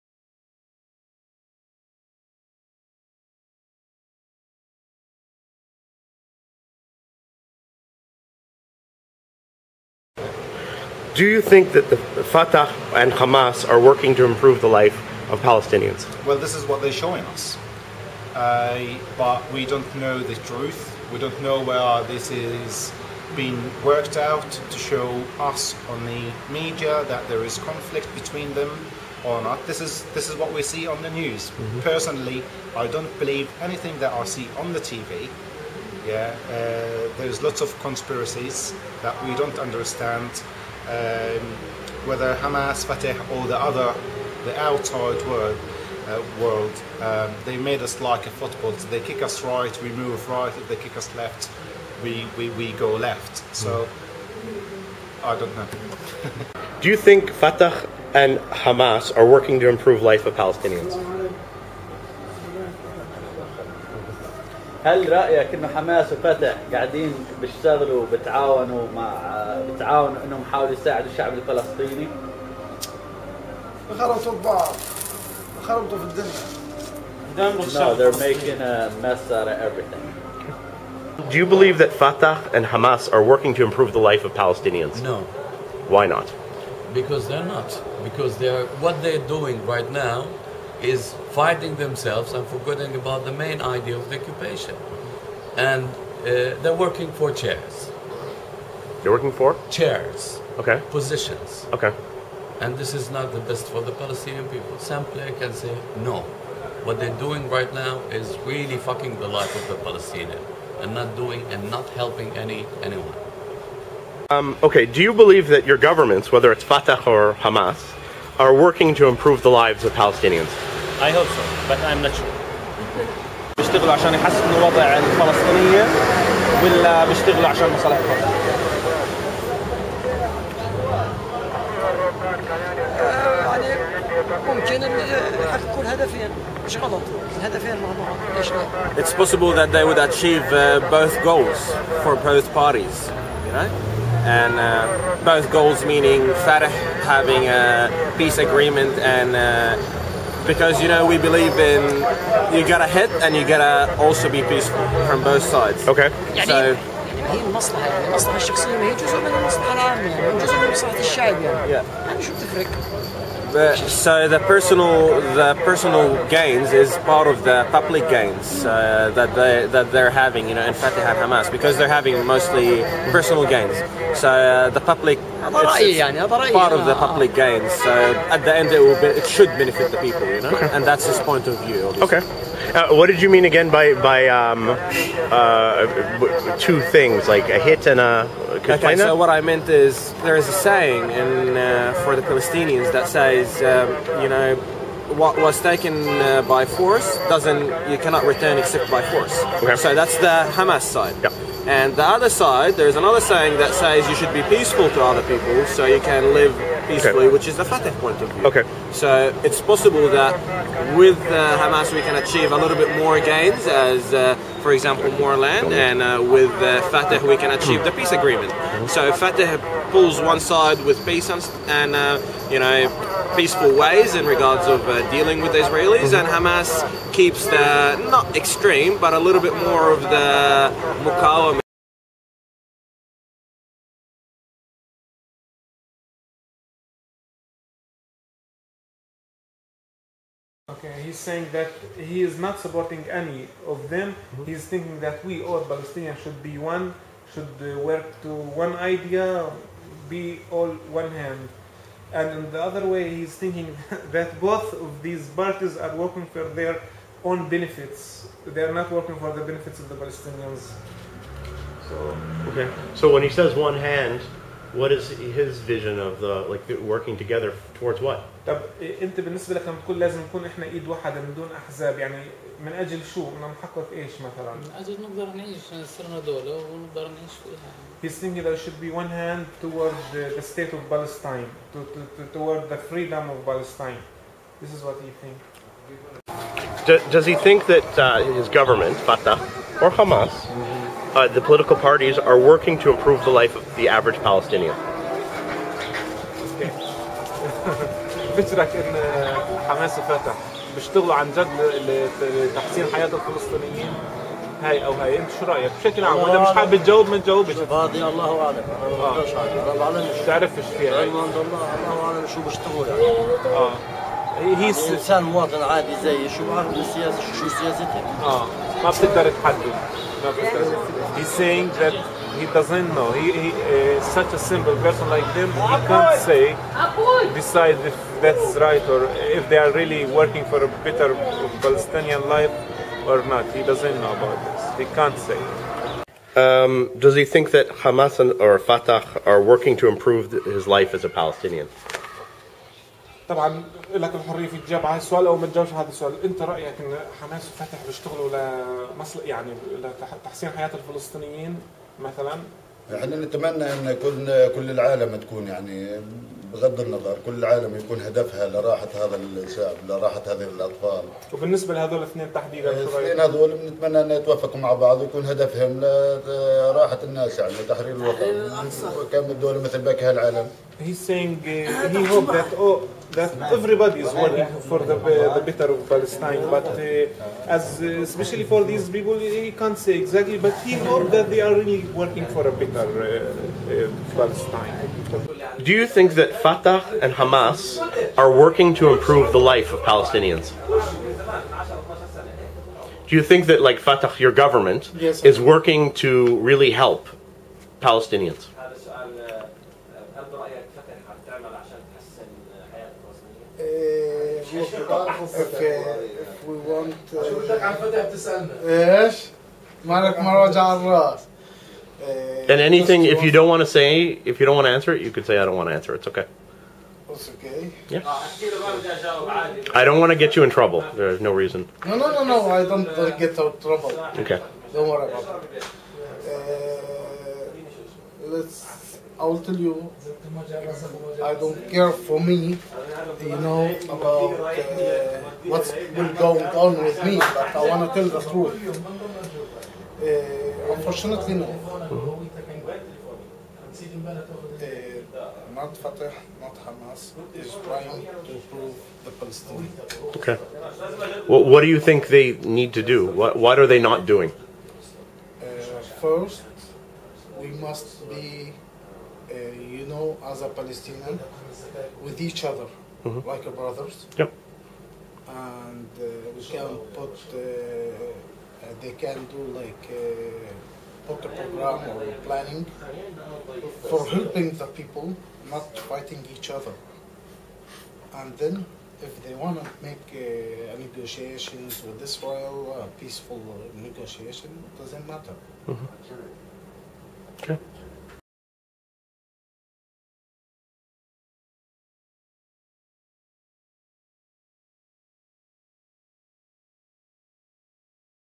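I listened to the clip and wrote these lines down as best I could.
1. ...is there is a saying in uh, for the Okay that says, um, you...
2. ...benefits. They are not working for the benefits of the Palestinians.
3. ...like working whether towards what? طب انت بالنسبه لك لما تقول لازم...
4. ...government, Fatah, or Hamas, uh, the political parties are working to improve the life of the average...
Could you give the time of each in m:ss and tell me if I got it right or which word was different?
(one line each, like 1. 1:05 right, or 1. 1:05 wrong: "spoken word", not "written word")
1. 3:09 wrong: "Palestinians", not "Okay"
2. 4:17 right
3. 4:26 wrong: "together", not "whether"
4. 4:48 right.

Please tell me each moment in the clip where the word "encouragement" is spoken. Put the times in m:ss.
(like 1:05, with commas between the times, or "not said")
not said.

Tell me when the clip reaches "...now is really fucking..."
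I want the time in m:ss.
1:47.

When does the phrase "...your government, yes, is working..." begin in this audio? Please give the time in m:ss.
6:34.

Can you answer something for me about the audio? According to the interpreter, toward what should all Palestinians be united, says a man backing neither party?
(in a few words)
the state of Palestine.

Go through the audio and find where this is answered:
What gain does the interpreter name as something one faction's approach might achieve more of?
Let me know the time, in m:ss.
3:35.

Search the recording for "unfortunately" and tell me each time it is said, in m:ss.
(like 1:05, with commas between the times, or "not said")
7:20.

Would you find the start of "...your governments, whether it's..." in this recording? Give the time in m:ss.
1:55.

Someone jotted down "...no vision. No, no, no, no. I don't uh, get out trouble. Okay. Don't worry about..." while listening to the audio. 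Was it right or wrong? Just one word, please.
wrong.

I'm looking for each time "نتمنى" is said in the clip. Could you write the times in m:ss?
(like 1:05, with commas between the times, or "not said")
5:53, 6:03.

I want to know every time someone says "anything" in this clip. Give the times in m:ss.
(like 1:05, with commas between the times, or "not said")
0:33, 6:52.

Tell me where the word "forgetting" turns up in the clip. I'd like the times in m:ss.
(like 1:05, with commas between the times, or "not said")
1:32.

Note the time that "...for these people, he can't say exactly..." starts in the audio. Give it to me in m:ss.
6:18.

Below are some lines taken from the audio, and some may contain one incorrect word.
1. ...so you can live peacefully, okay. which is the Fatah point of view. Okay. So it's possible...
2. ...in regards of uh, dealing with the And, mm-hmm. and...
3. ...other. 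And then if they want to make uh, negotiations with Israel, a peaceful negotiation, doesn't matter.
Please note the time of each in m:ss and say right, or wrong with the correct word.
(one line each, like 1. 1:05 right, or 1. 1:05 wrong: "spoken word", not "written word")
1. 3:25 right
2. 3:44 wrong: "Israelis", not "And"
3. 7:56 right.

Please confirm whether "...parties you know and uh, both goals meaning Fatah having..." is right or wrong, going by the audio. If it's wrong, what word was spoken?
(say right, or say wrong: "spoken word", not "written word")
right.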